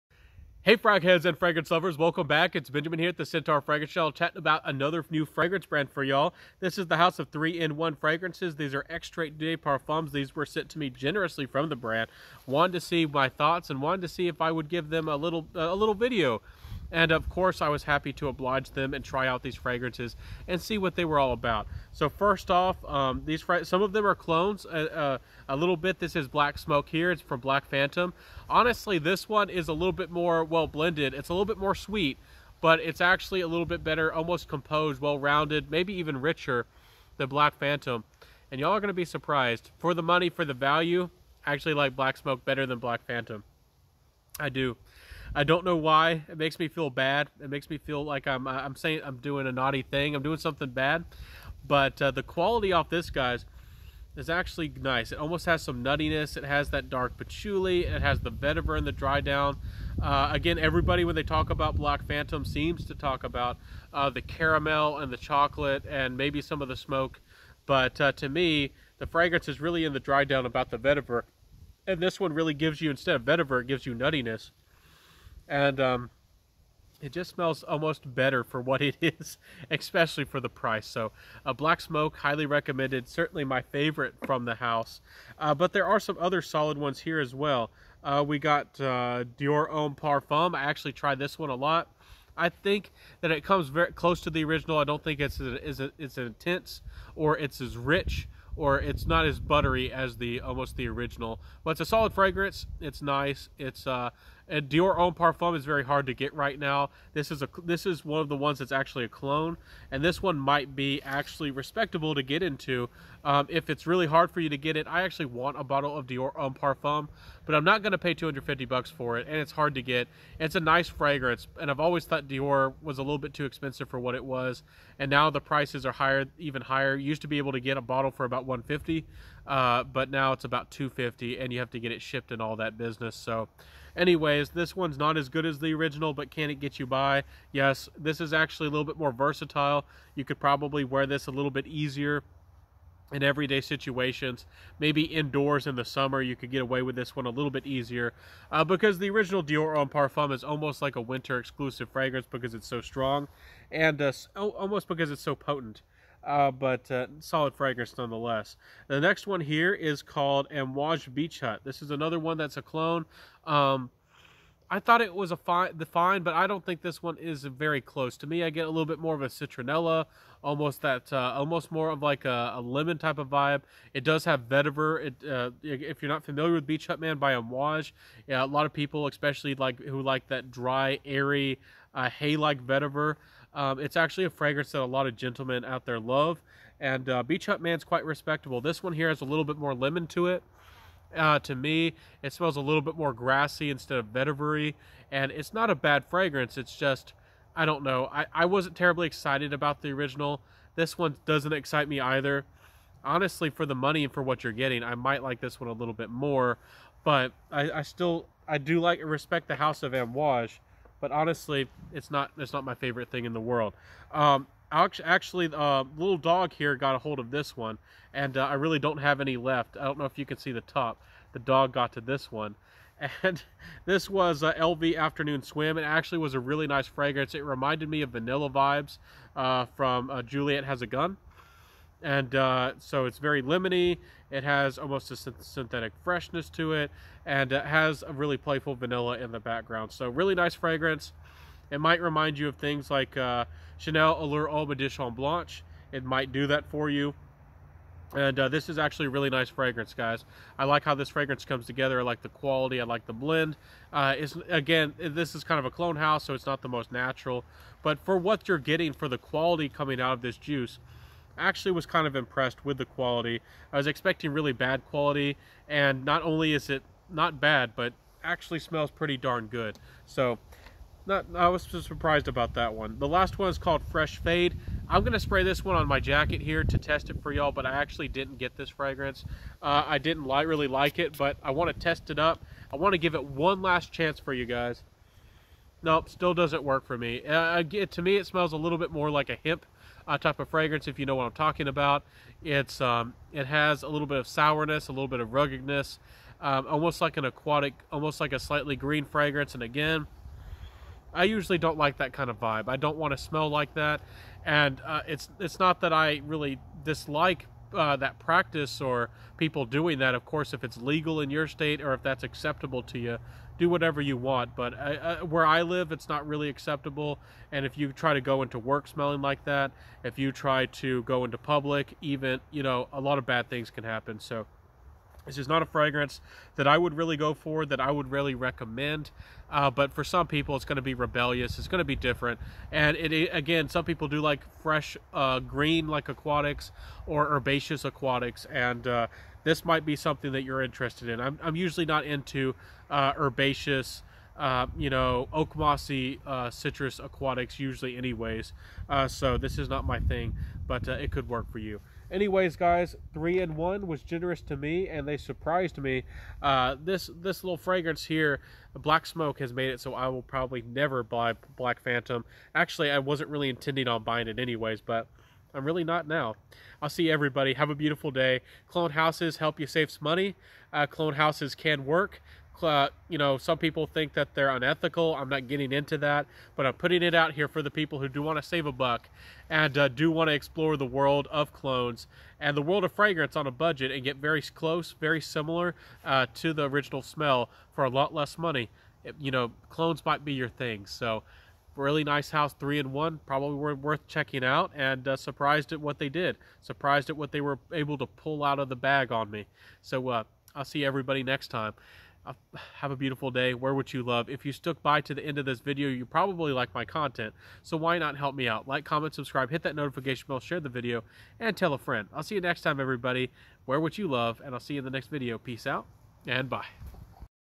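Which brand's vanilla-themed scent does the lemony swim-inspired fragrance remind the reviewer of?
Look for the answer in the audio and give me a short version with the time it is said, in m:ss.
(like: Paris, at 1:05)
Juliette Has a Gun, at 3:50.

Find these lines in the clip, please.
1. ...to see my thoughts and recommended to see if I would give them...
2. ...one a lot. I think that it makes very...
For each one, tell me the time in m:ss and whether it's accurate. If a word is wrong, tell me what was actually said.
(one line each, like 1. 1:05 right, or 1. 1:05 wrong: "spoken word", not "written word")
1. 0:12 wrong: "wanted", not "recommended"
2. 1:31 wrong: "comes", not "makes".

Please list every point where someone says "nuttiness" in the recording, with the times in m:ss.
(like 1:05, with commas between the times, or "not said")
0:55, 1:13.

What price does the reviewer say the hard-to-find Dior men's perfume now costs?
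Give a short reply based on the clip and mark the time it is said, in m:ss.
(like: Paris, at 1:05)
$250, at 1:58.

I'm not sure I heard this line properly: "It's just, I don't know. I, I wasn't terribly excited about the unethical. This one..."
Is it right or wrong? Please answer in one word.
wrong.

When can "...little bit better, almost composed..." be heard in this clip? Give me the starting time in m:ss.
0:33.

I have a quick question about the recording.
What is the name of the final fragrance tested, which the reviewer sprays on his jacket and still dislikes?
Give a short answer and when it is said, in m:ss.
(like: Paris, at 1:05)
Fresh Fade, at 4:33.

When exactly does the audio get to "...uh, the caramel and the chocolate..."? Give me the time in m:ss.
1:03.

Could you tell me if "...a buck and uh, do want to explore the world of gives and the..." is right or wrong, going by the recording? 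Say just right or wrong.
wrong.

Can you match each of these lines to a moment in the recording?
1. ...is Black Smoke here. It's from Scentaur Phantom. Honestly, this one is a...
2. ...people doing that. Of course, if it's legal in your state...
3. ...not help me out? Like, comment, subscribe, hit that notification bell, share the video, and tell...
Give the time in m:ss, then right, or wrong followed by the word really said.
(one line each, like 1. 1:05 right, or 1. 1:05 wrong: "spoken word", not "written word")
1. 0:26 wrong: "Black", not "Scentaur"
2. 5:09 right
3. 6:47 right.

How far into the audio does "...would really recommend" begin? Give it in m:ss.
5:27.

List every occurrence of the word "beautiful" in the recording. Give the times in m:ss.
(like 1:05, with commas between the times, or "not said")
6:07, 6:42.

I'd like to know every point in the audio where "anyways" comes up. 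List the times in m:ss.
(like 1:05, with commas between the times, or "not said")
2:13, 5:47, 5:52, 6:04.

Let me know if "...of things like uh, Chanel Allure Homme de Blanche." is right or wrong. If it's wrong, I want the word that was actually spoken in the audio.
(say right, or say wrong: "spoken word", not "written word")
right.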